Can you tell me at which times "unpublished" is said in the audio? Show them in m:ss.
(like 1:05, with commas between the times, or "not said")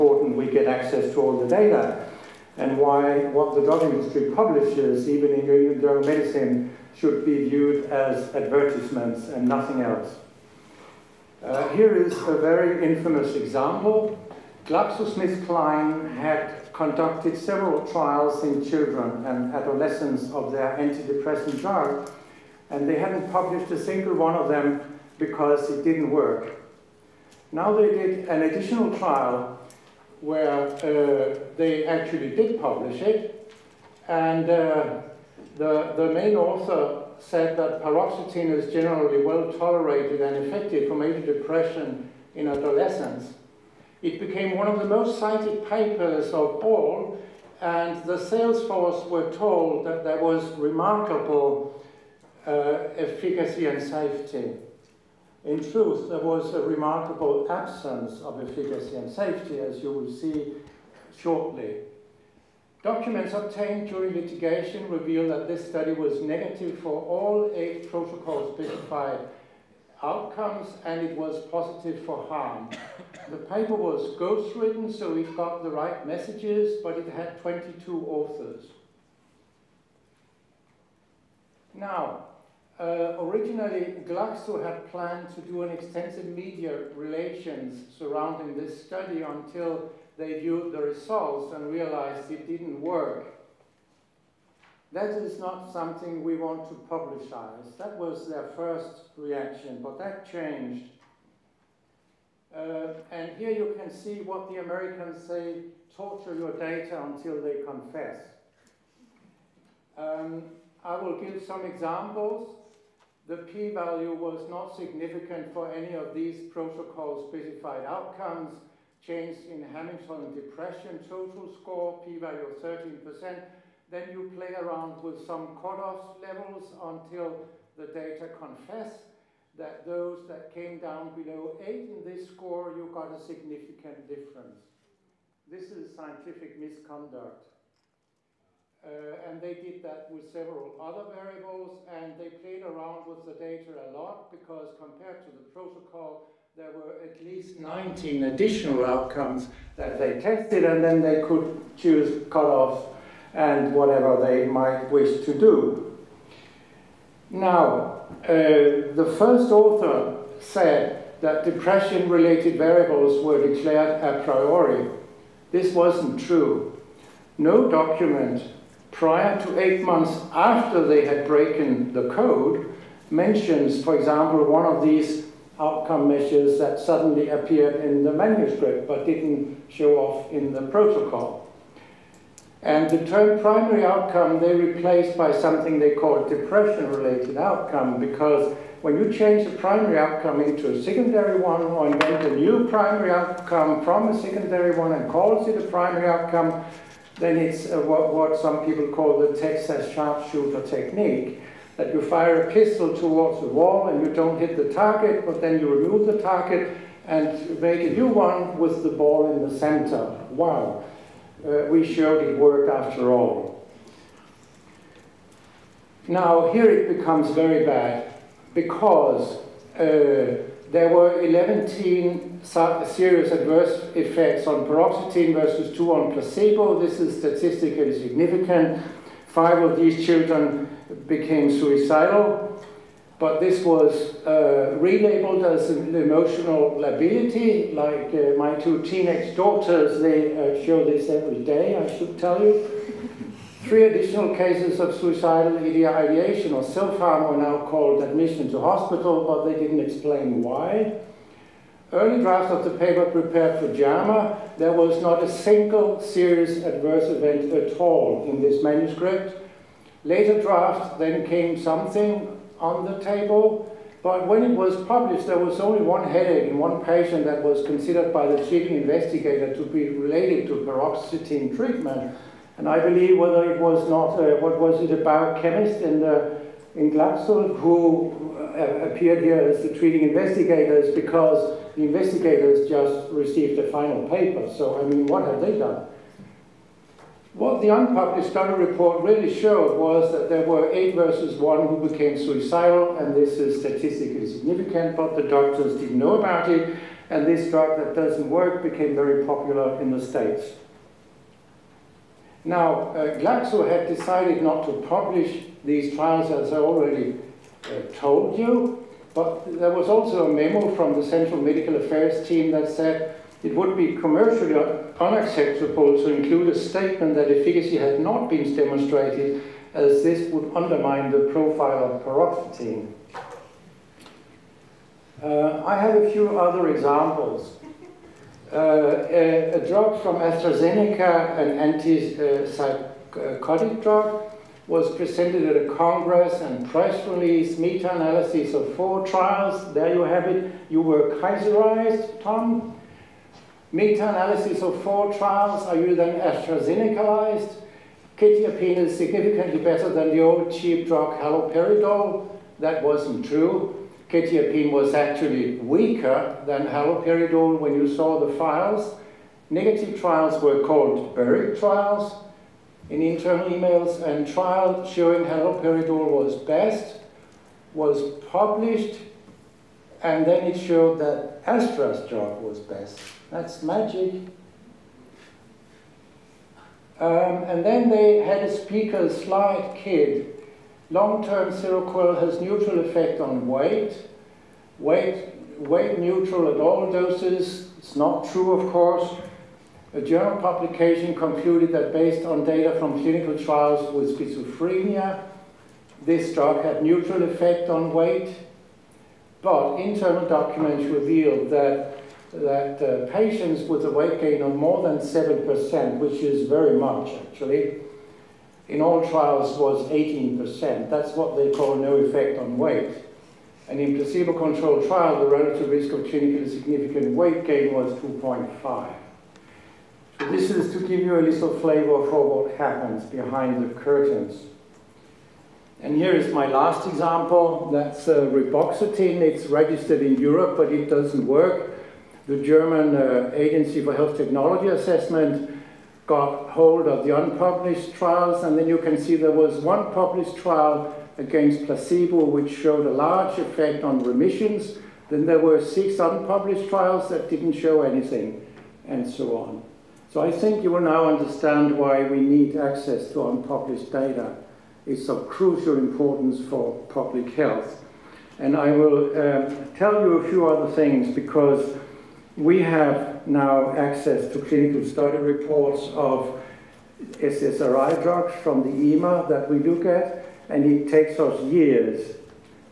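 4:47, 7:17, 7:25, 7:33.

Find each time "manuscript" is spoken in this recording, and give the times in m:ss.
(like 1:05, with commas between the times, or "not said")
2:58, 4:18.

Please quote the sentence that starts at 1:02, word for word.
Documents obtained during litigation reveal that this study was negative for all eight protocol specified outcomes, and it was positive for harm.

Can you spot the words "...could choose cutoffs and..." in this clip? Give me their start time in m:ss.
2:31.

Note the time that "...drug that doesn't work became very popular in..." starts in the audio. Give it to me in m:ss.
4:57.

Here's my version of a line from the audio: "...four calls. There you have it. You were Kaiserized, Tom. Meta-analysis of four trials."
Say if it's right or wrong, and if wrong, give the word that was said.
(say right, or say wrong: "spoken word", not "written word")
wrong: "trials", not "calls".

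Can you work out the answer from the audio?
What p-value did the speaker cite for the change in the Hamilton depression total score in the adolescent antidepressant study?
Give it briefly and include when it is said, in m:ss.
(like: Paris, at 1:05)
13%, at 2:02.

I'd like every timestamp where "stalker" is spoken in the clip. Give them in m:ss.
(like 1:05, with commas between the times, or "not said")
not said.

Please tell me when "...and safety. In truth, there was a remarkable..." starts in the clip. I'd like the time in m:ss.
0:53.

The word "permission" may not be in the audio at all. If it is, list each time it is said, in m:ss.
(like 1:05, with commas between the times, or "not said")
not said.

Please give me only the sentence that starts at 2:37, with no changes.
Now, uh, the first author said that depression-related variables were declared a priori.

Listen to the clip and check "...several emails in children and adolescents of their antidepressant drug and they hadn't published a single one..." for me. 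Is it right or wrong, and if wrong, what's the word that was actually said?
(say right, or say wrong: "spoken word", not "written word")
wrong: "trials", not "emails".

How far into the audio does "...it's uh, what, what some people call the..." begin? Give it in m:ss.
3:17.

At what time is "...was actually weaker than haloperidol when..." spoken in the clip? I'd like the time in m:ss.
5:54.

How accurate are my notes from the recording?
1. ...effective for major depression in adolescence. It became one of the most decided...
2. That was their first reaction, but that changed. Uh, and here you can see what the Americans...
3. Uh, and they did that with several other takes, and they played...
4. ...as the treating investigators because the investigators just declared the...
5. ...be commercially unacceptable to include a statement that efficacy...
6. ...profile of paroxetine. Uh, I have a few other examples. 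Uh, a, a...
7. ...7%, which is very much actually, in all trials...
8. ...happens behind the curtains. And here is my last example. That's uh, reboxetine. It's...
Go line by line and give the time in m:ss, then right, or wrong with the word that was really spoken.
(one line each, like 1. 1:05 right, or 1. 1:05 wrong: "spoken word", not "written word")
1. 0:40 wrong: "cited", not "decided"
2. 1:37 right
3. 2:18 wrong: "variables", not "takes"
4. 4:39 wrong: "received", not "declared"
5. 5:13 right
6. 5:21 right
7. 6:44 right
8. 7:02 right.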